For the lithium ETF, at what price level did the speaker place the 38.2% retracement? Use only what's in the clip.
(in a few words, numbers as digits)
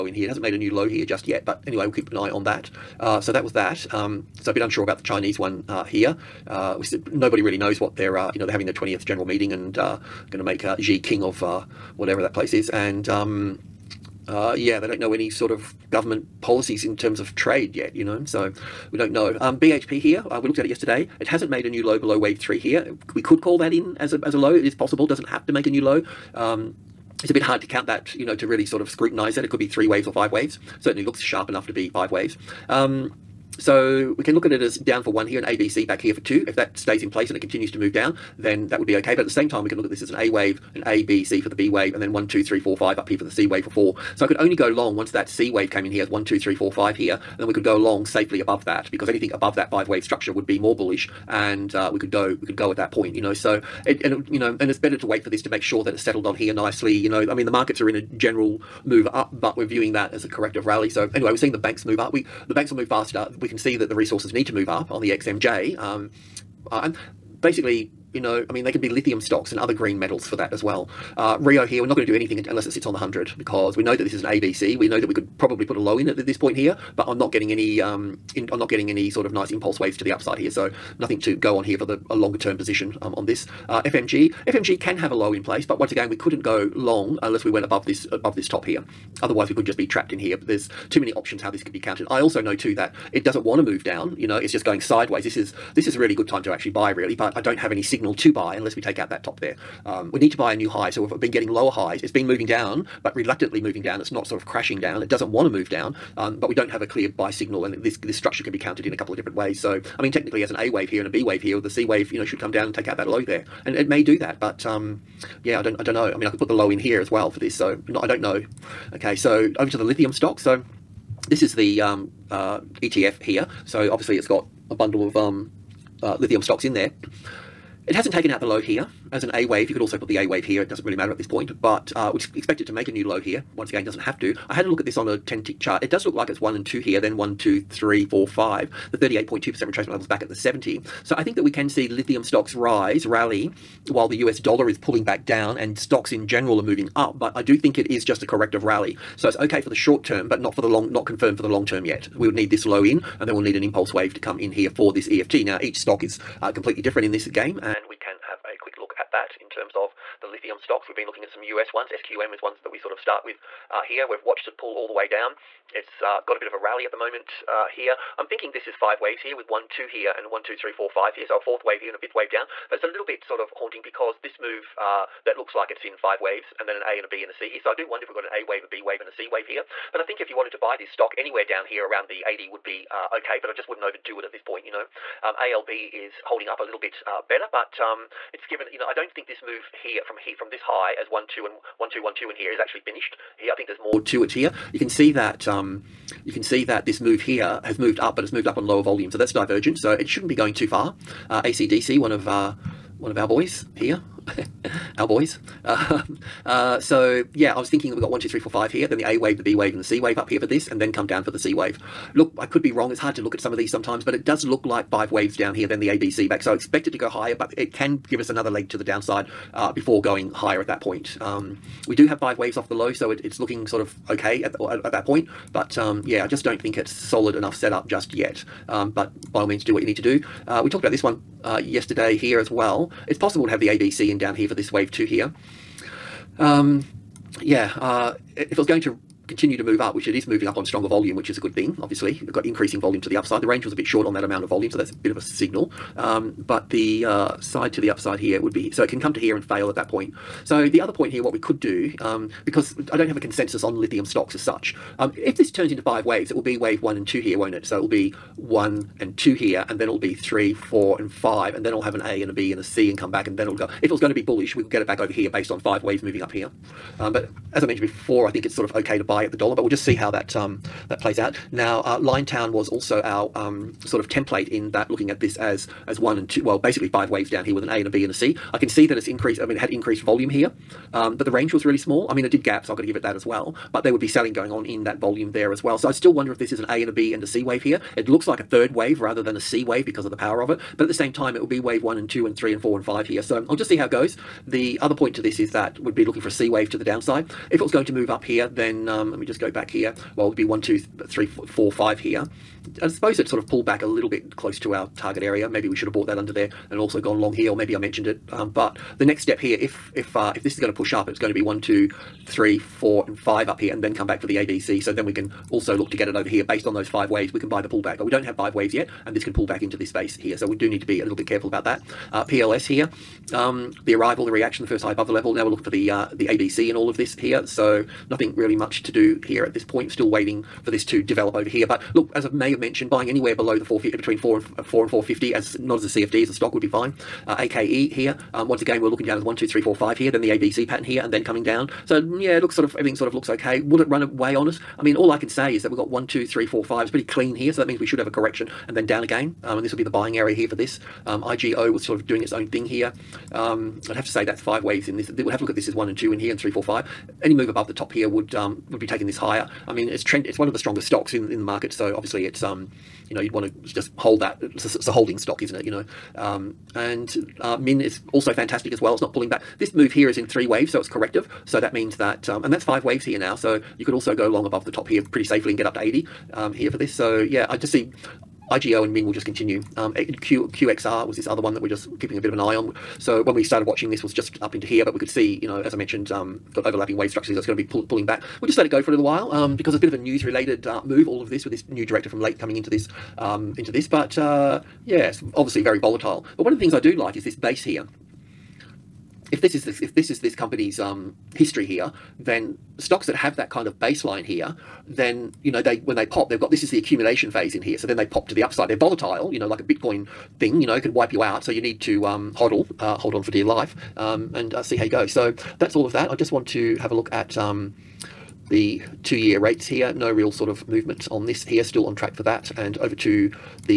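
70.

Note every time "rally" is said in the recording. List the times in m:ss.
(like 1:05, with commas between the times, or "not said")
1:00, 2:23, 2:28, 2:46.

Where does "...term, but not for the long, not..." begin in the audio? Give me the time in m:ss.
2:30.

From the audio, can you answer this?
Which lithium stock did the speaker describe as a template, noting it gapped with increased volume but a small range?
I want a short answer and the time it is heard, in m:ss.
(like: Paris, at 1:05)
Liontown, at 4:31.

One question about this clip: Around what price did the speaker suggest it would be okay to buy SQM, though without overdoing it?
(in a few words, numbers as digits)
80.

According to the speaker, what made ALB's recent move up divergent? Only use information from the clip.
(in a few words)
lower volume.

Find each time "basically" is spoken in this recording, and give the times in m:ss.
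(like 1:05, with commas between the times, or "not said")
1:07, 4:36.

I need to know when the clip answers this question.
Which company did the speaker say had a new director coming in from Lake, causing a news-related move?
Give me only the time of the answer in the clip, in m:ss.
6:20.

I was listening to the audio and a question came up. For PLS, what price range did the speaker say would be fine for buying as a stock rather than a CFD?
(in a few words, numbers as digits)
4 to 4.50.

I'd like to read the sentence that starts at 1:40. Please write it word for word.
So we've been getting lower highs.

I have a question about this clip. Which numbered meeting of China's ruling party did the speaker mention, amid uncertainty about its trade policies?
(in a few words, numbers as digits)
20th.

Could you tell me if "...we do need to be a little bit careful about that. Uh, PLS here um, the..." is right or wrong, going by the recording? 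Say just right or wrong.
right.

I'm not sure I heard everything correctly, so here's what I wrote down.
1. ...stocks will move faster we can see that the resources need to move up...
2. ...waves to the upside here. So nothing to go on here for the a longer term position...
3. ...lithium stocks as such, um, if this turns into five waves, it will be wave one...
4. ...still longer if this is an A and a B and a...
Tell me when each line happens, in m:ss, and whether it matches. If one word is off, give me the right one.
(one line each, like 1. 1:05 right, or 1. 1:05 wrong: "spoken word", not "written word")
1. 1:02 wrong: "banks", not "stocks"
2. 1:19 right
3. 4:13 right
4. 4:45 wrong: "wonder", not "longer".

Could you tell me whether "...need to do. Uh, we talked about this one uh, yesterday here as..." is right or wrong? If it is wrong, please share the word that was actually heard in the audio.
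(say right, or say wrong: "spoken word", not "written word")
right.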